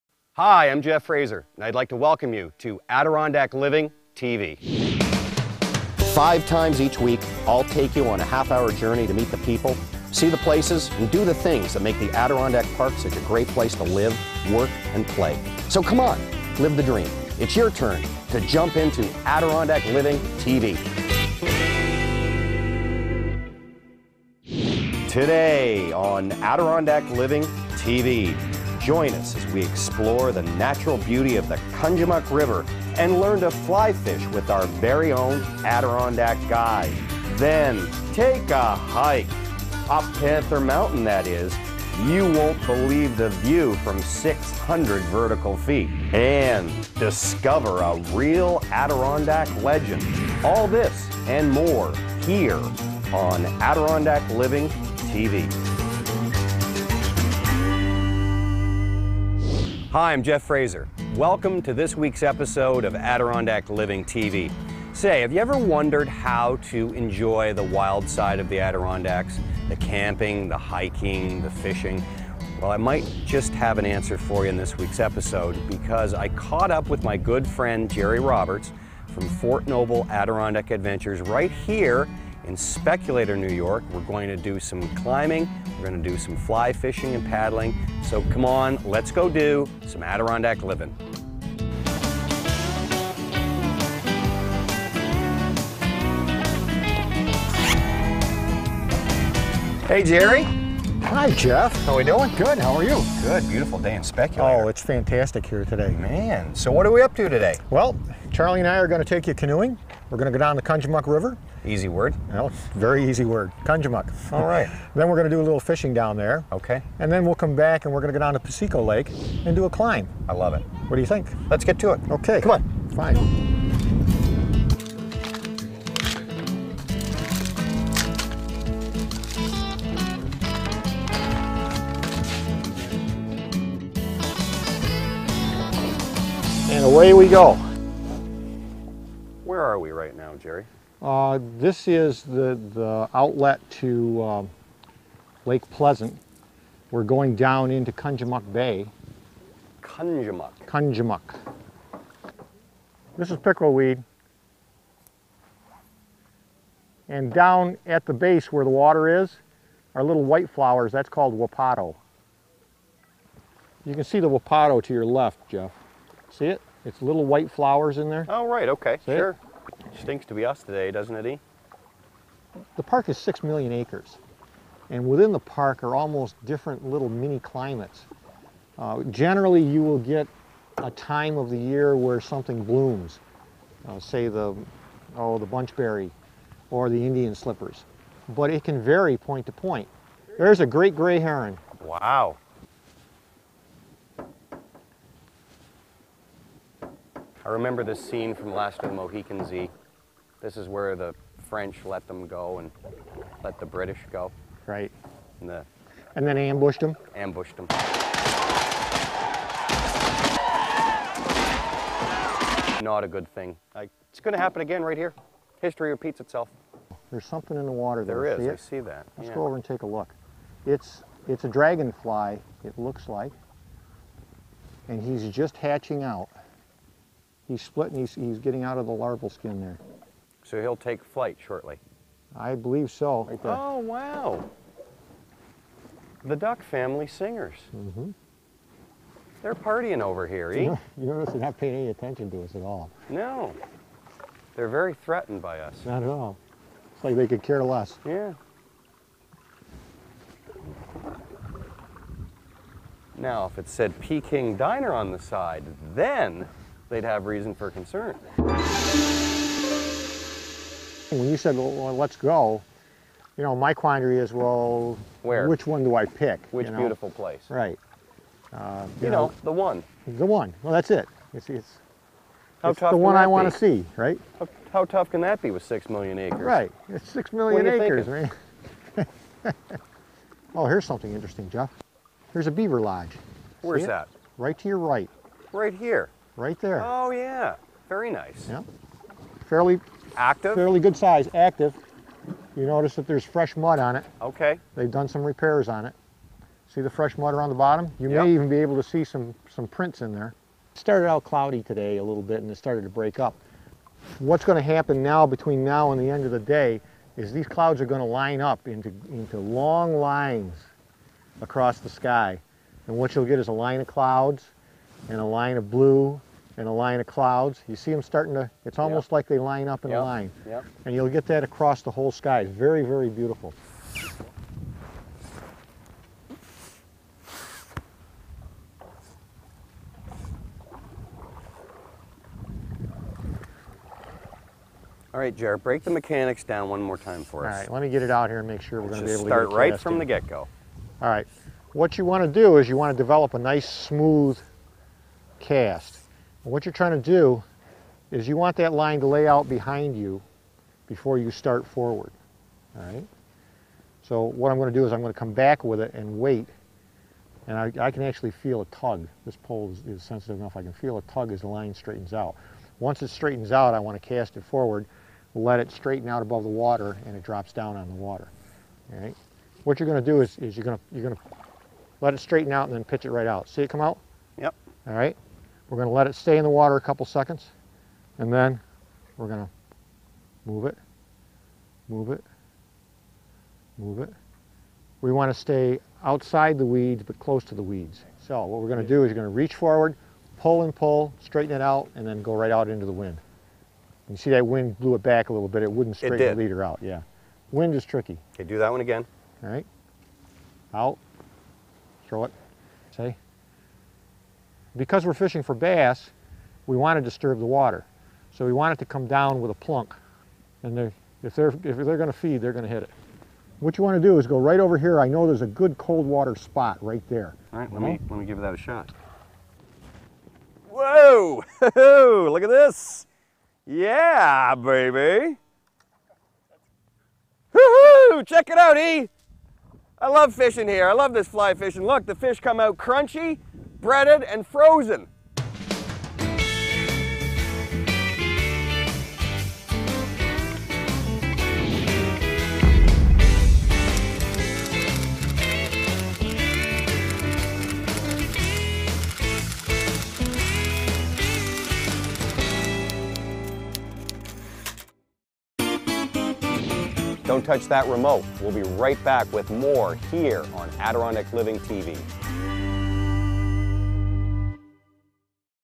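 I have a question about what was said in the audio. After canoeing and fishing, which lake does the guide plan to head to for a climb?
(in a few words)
Piseco Lake.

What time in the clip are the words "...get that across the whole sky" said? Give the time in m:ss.
5:21.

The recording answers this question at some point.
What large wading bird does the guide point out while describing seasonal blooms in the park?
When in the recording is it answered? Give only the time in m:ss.
3:10.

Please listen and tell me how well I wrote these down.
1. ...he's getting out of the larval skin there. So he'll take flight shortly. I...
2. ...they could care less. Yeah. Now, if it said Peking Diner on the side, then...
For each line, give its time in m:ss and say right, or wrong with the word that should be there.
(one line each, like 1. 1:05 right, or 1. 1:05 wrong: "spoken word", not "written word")
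1. 3:48 right
2. 4:07 right.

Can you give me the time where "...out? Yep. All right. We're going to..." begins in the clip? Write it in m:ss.
6:13.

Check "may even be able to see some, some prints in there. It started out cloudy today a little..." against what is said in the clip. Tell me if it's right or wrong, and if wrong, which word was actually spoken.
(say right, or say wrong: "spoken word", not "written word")
right.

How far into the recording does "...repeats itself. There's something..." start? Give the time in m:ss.
3:35.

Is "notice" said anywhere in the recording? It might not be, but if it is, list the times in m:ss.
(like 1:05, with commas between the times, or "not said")
4:01, 4:52.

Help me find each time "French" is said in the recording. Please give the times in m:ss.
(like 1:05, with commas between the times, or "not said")
3:21.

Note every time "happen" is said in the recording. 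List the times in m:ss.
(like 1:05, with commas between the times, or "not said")
3:34, 5:04.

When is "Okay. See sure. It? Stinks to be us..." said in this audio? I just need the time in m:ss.
2:48.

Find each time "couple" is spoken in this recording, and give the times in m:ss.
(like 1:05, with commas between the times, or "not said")
6:16.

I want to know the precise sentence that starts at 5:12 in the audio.
And what you'll get is a line of clouds and a line of blue and a line of clouds.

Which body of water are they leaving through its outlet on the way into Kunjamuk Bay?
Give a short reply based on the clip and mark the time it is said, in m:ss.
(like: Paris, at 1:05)
Lake Pleasant, at 2:25.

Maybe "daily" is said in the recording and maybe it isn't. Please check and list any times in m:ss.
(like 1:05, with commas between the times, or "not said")
not said.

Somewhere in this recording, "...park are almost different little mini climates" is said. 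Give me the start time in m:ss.
2:55.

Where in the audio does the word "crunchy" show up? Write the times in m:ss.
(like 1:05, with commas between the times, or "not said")
7:12.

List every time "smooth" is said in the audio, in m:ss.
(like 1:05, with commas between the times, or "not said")
5:43.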